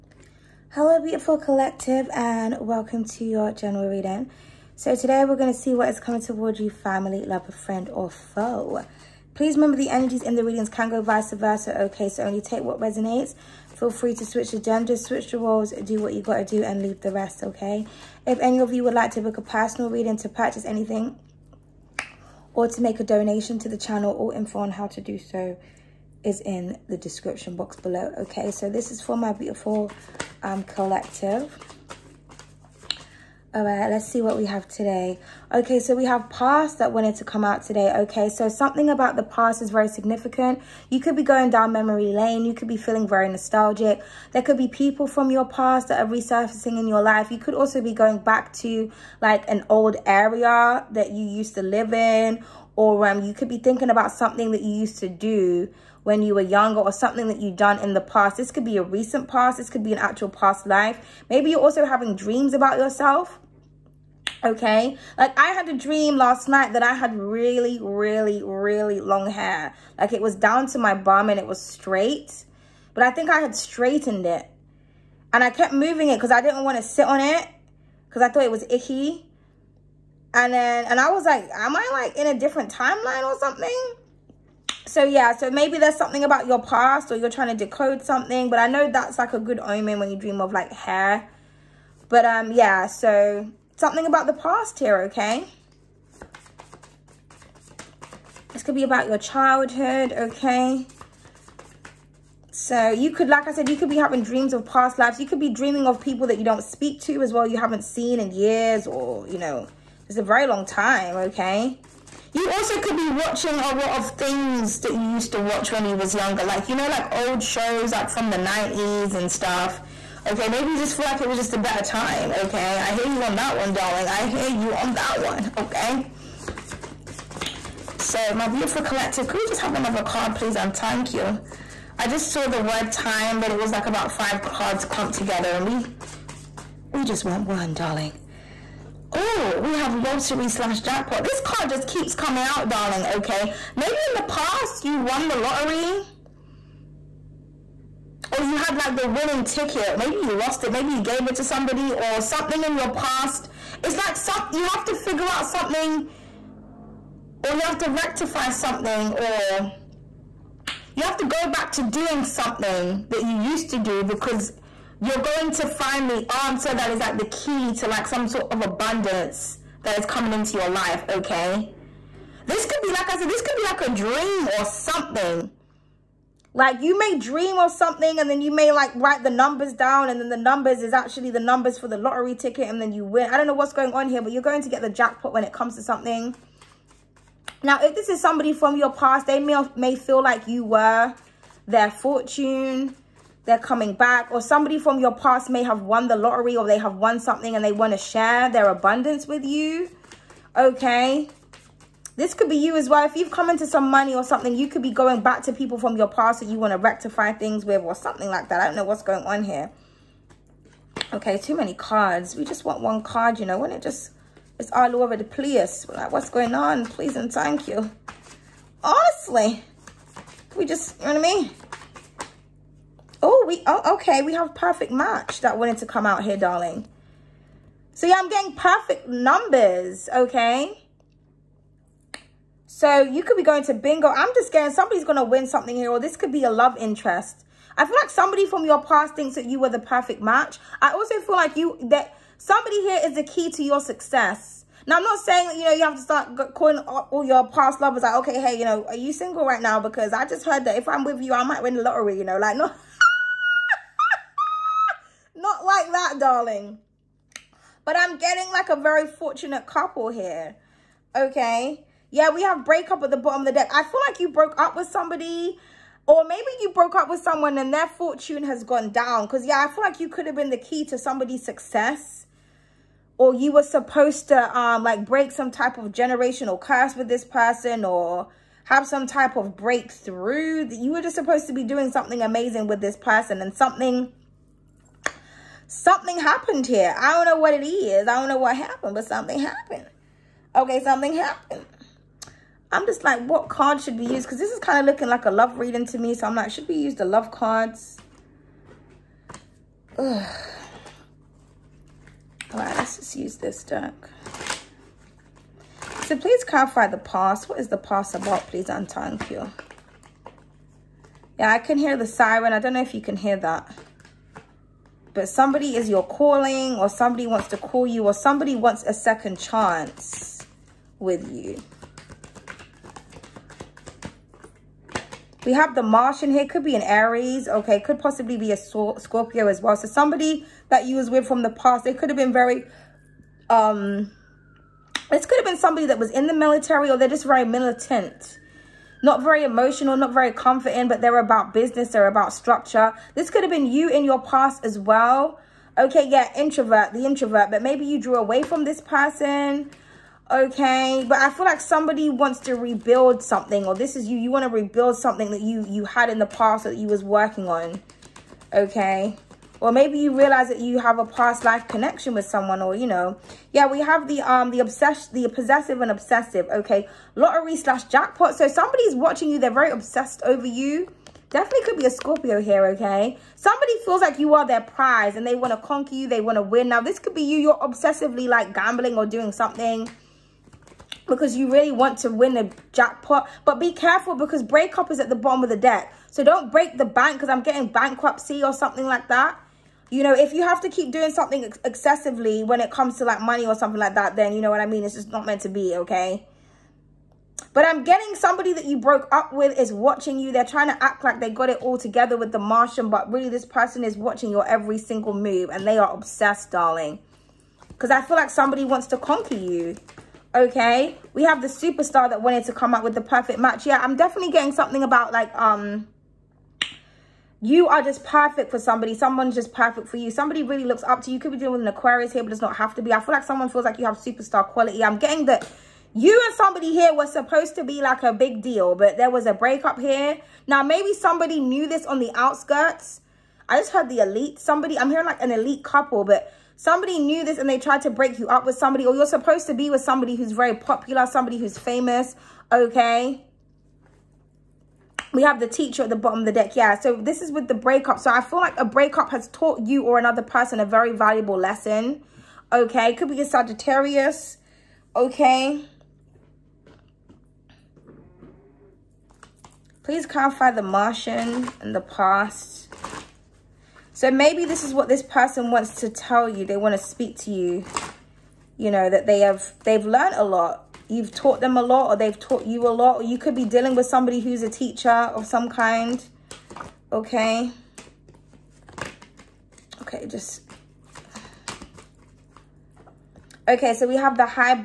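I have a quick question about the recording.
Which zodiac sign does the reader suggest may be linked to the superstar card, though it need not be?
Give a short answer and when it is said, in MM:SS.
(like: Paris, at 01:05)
Aquarius, at 07:01.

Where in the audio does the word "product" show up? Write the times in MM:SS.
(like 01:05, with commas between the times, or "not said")
not said.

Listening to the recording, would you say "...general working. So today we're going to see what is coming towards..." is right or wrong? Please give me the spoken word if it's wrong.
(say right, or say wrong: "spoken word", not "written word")
wrong: "reading", not "working".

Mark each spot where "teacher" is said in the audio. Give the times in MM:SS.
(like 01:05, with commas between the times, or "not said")
07:25, 07:54.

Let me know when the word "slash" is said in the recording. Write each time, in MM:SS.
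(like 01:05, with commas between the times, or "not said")
02:20, 06:07.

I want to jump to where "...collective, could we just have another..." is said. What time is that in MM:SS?
02:08.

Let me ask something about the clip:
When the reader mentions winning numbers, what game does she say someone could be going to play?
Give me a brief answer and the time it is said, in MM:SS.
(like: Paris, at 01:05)
Bingo, at 03:53.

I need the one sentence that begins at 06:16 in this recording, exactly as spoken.
Now, this could be you, you're obsessively like gambling or doing something because you really want to win a jackpot.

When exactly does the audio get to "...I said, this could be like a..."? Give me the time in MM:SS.
02:53.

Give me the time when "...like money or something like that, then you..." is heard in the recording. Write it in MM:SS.
06:33.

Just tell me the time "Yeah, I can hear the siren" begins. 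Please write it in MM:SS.
05:11.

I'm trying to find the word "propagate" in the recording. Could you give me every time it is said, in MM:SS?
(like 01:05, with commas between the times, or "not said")
not said.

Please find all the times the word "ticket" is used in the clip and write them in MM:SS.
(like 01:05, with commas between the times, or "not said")
02:29, 03:02.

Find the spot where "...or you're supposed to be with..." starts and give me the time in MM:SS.
07:18.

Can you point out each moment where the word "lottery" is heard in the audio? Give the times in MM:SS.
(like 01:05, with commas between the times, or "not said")
02:19, 02:25, 03:01, 03:16, 04:11, 06:07.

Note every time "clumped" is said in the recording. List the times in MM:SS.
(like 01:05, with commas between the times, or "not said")
02:14.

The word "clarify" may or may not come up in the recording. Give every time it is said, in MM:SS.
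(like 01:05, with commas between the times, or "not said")
05:06, 07:40.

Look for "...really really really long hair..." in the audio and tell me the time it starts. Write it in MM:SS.
01:07.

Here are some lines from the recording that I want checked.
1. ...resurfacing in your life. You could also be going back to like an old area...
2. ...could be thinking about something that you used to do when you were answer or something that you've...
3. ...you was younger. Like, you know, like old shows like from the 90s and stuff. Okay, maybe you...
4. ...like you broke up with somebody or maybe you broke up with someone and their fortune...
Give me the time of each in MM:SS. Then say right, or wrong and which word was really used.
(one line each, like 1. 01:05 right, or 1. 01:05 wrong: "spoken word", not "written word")
1. 00:46 right
2. 00:53 wrong: "younger", not "answer"
3. 01:55 right
4. 04:24 right.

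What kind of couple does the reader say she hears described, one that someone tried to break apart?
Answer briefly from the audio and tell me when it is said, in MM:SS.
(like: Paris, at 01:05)
An elite couple, at 07:15.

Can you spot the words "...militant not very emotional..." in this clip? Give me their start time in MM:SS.
05:37.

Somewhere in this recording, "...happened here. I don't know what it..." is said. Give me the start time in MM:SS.
04:46.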